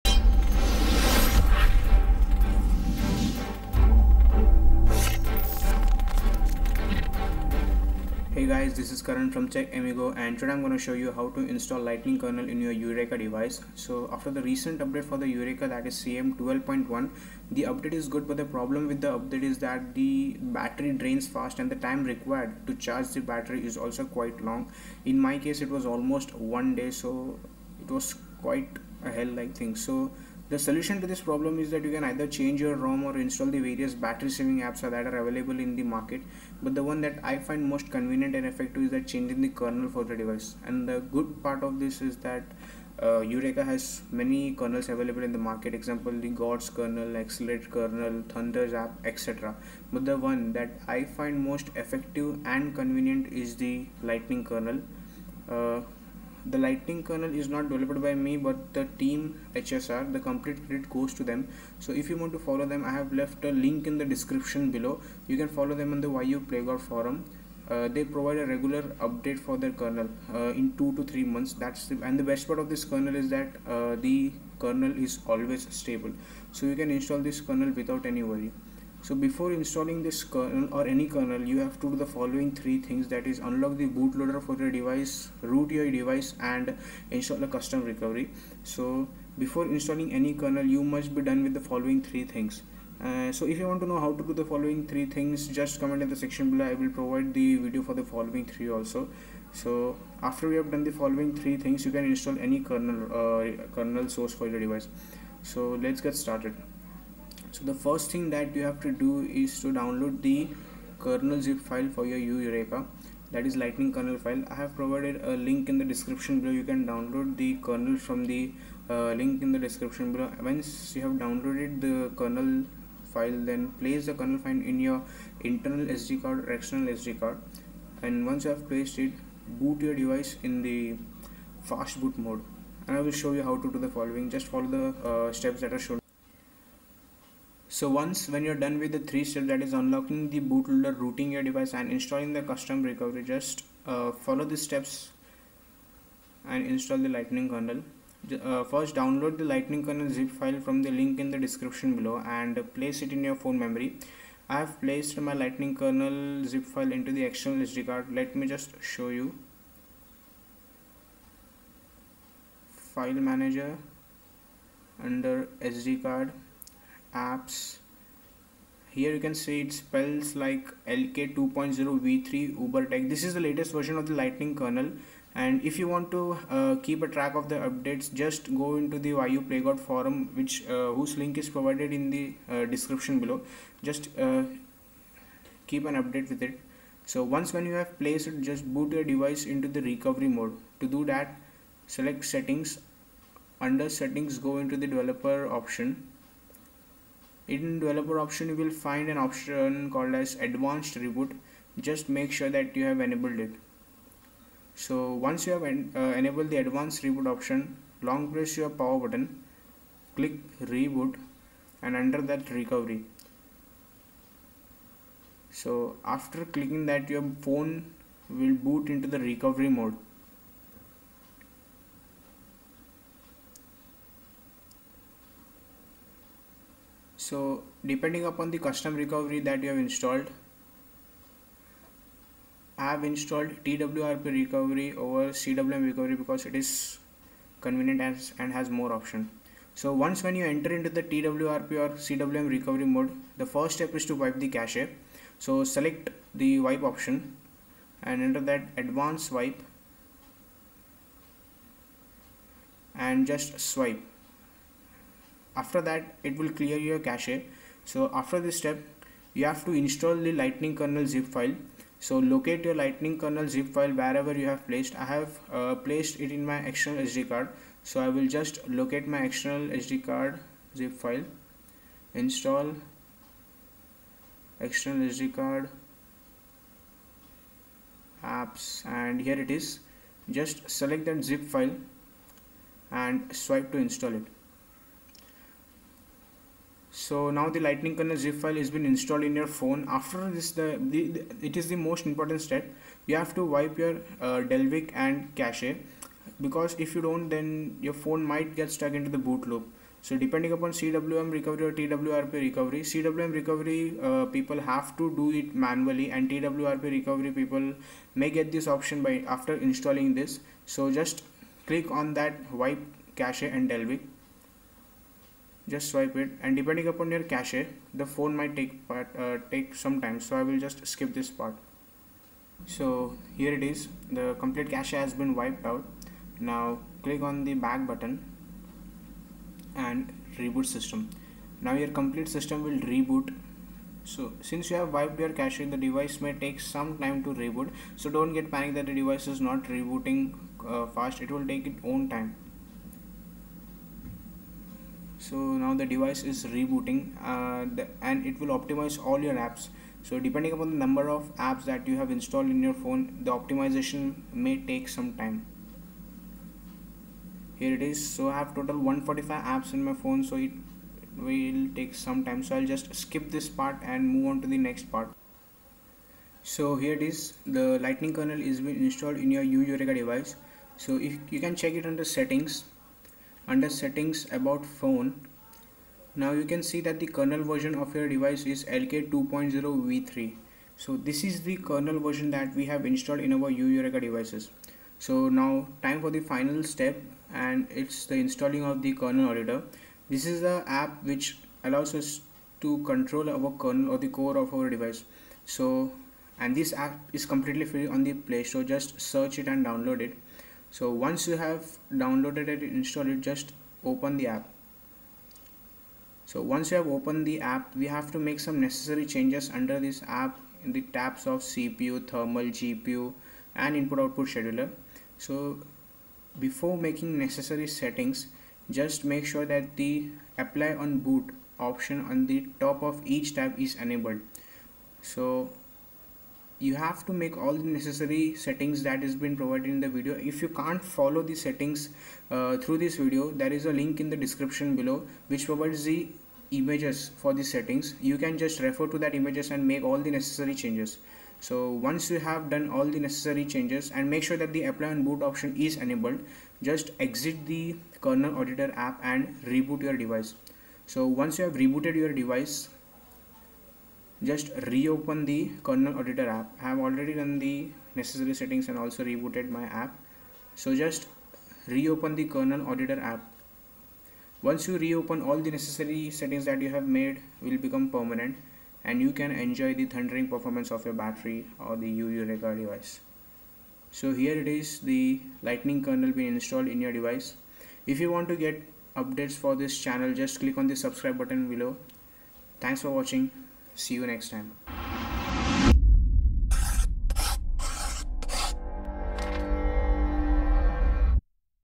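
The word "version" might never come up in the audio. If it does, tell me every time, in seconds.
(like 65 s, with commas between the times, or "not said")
173 s, 377 s, 381 s.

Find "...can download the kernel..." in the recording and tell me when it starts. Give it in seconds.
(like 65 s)
116 s.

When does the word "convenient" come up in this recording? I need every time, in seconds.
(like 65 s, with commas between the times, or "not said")
37 s, 52 s, 237 s.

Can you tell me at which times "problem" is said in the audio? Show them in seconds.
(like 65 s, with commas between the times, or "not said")
18 s, 31 s.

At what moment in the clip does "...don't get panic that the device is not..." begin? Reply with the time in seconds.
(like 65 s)
338 s.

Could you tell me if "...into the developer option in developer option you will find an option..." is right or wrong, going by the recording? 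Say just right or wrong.
right.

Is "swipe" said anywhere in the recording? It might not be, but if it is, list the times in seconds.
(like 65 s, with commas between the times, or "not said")
253 s, 283 s, 315 s.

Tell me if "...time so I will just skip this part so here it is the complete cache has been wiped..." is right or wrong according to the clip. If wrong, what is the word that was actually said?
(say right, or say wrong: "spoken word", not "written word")
right.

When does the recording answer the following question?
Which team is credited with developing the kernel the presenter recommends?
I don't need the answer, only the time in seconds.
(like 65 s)
58 s.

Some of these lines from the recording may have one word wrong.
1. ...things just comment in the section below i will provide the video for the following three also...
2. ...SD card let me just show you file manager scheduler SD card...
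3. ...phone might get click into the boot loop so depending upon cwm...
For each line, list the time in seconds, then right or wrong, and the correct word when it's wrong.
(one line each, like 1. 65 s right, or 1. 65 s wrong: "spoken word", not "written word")
1. 95 s right
2. 157 s wrong: "under", not "scheduler"
3. 297 s wrong: "stuck", not "click".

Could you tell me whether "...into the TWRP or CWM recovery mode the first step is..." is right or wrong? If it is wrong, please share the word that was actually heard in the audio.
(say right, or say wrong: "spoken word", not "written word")
right.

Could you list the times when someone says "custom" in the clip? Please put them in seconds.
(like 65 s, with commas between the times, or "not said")
87 s, 142 s, 228 s.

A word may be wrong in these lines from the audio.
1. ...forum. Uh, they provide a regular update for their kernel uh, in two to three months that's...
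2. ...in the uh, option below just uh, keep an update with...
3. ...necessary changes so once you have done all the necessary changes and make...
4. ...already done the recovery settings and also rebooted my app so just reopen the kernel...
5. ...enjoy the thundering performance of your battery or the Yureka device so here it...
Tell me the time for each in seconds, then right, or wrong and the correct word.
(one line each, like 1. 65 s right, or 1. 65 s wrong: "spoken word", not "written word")
1. 66 s right
2. 181 s wrong: "description", not "option"
3. 440 s right
4. 456 s wrong: "necessary", not "recovery"
5. 469 s right.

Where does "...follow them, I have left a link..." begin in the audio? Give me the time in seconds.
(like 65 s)
62 s.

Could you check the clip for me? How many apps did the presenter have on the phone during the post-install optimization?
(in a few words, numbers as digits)
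145.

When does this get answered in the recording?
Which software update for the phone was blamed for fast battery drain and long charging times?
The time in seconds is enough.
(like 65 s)
15 s.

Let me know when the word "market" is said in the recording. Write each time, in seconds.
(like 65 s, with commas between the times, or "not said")
35 s, 45 s.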